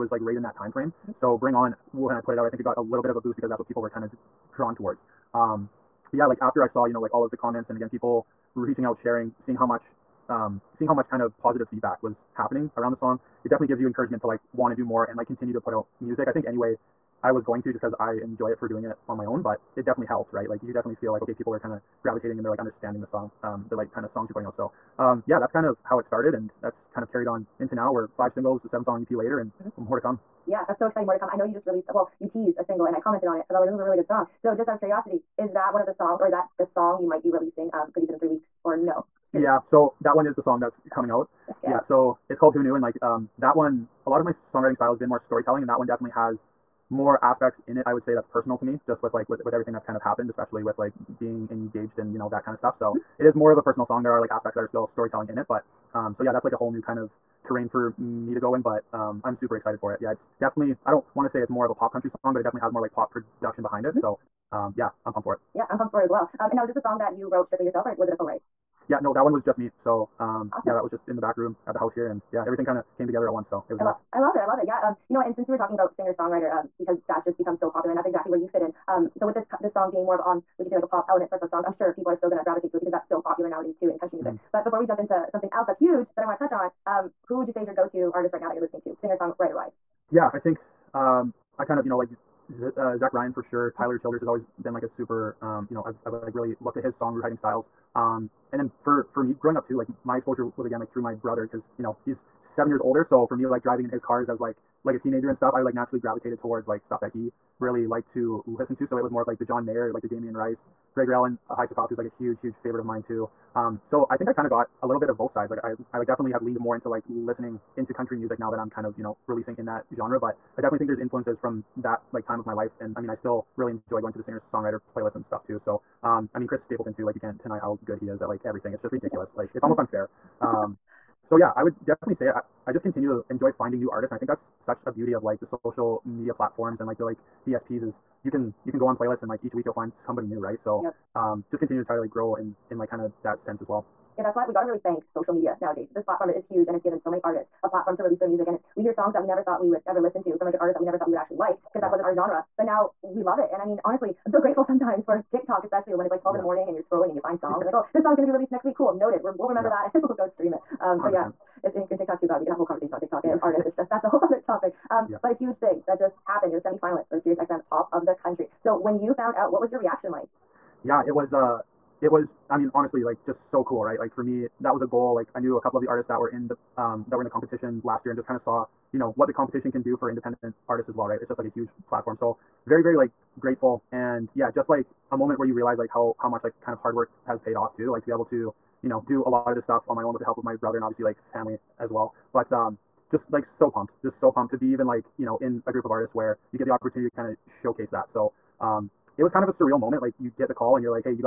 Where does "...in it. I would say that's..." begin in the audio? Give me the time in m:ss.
0:47.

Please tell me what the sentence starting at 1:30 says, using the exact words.
Yeah, I think um, I kind of you know like Z- uh, Zach Bryan for sure.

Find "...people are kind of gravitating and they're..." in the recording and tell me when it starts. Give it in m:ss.
0:21.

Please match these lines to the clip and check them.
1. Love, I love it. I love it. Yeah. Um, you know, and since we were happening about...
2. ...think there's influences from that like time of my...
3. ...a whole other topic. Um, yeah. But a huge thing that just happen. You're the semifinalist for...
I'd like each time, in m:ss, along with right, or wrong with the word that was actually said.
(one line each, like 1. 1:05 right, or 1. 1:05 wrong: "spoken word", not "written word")
1. 1:13 wrong: "talking", not "happening"
2. 2:00 right
3. 2:44 right.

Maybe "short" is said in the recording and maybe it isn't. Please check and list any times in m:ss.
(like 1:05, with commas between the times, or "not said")
not said.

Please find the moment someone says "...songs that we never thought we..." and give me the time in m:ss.
2:28.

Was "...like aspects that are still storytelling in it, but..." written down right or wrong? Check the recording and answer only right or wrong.
right.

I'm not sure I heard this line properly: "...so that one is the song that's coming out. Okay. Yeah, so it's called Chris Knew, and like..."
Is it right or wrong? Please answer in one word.
wrong.